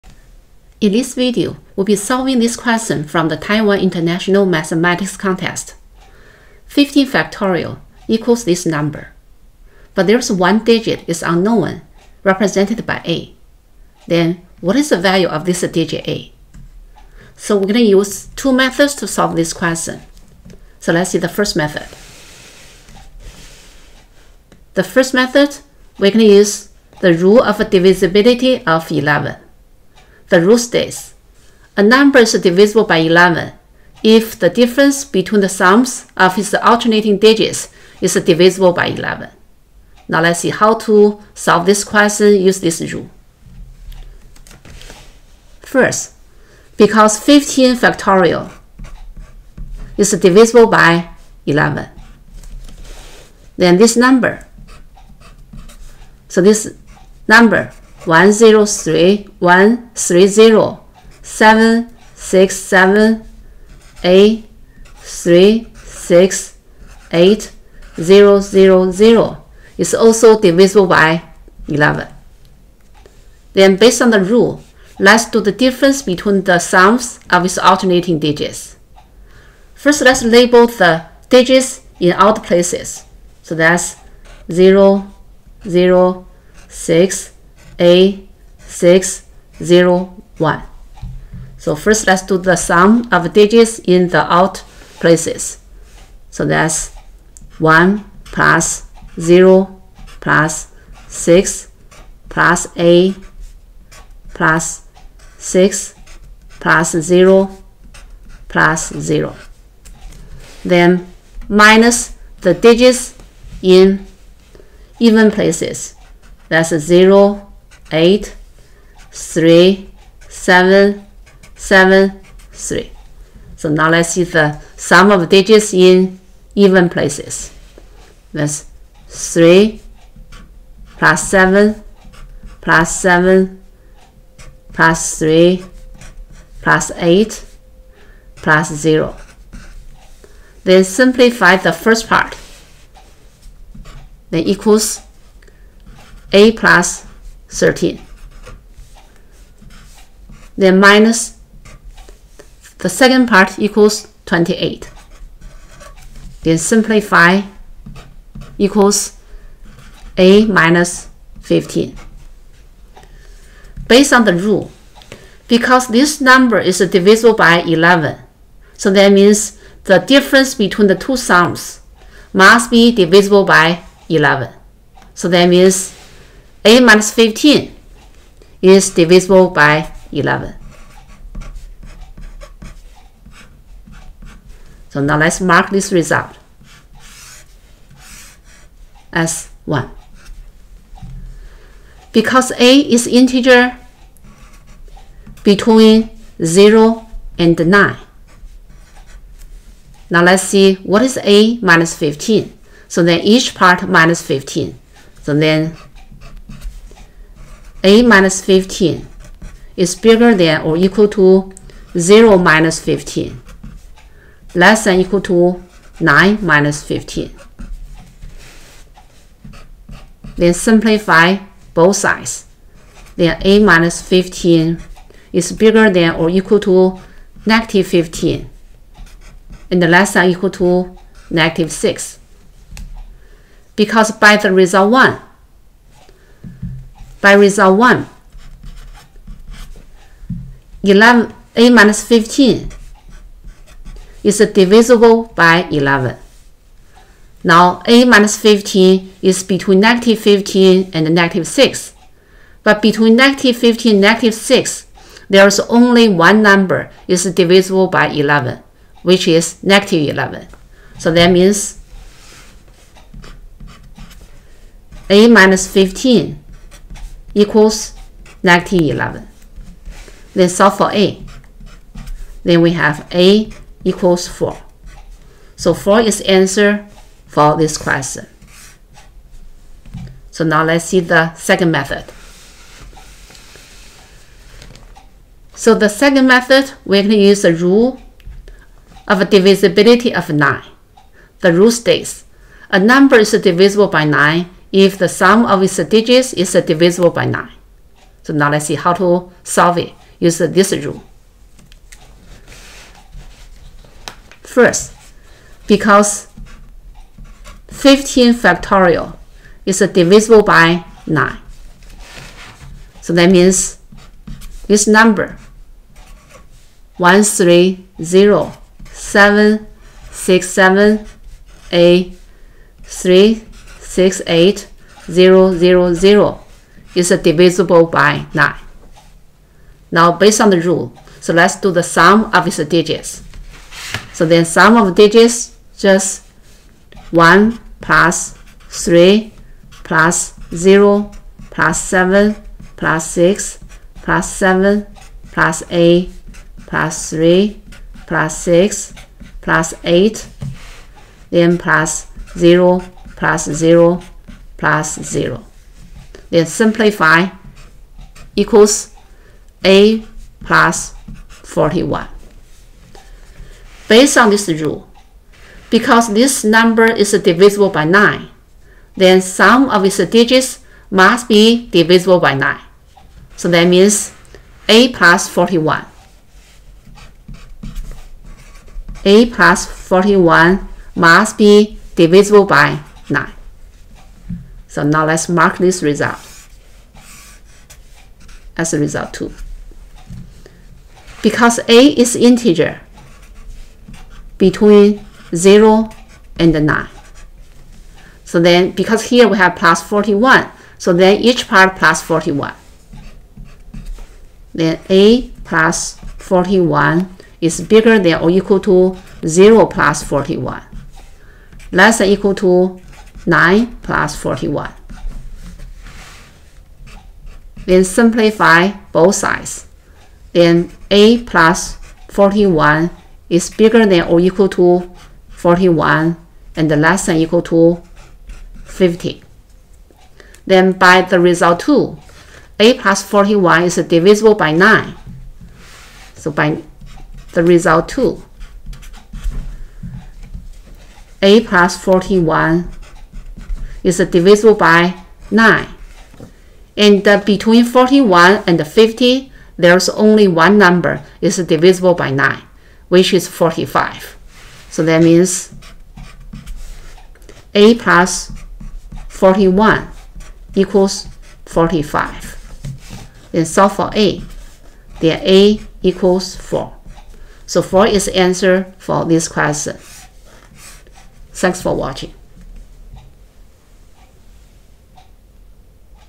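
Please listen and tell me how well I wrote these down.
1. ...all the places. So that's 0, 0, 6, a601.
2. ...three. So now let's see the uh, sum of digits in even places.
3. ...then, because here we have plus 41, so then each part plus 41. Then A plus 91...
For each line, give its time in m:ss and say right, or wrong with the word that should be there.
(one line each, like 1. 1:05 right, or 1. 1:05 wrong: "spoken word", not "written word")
1. 1:22 right
2. 2:02 right
3. 6:38 wrong: "41", not "91".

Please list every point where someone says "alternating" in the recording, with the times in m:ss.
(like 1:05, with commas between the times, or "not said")
0:36, 1:17.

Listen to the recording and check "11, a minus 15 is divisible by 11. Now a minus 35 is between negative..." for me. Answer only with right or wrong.
wrong.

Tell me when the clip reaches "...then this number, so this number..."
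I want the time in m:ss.
0:53.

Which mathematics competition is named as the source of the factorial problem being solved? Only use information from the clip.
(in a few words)
Taiwan International Mathematics Contest.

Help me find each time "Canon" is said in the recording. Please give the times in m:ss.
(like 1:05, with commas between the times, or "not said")
not said.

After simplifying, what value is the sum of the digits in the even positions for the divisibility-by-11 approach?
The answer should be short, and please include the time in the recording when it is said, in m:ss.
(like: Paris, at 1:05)
28, at 2:34.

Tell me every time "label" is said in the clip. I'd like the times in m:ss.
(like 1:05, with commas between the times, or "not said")
1:20.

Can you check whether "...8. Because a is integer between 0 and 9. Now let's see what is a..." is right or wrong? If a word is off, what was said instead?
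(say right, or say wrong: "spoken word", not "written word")
wrong: "1", not "8".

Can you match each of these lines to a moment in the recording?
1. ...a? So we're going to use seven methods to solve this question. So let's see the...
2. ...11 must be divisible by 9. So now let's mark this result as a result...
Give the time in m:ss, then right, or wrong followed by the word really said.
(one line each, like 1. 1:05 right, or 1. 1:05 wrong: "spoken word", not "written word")
1. 0:16 wrong: "two", not "seven"
2. 6:19 wrong: "41", not "11".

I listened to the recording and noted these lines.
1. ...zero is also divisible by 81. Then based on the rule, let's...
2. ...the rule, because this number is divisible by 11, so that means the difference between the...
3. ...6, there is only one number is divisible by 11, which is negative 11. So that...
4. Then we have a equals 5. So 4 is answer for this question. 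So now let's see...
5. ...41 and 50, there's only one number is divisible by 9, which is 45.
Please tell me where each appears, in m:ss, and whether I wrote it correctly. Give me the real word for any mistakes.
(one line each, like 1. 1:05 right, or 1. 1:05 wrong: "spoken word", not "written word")
1. 1:08 wrong: "11", not "81"
2. 2:44 right
3. 4:14 right
4. 4:32 wrong: "4", not "5"
5. 7:27 right.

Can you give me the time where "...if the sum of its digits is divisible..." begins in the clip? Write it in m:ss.
4:54.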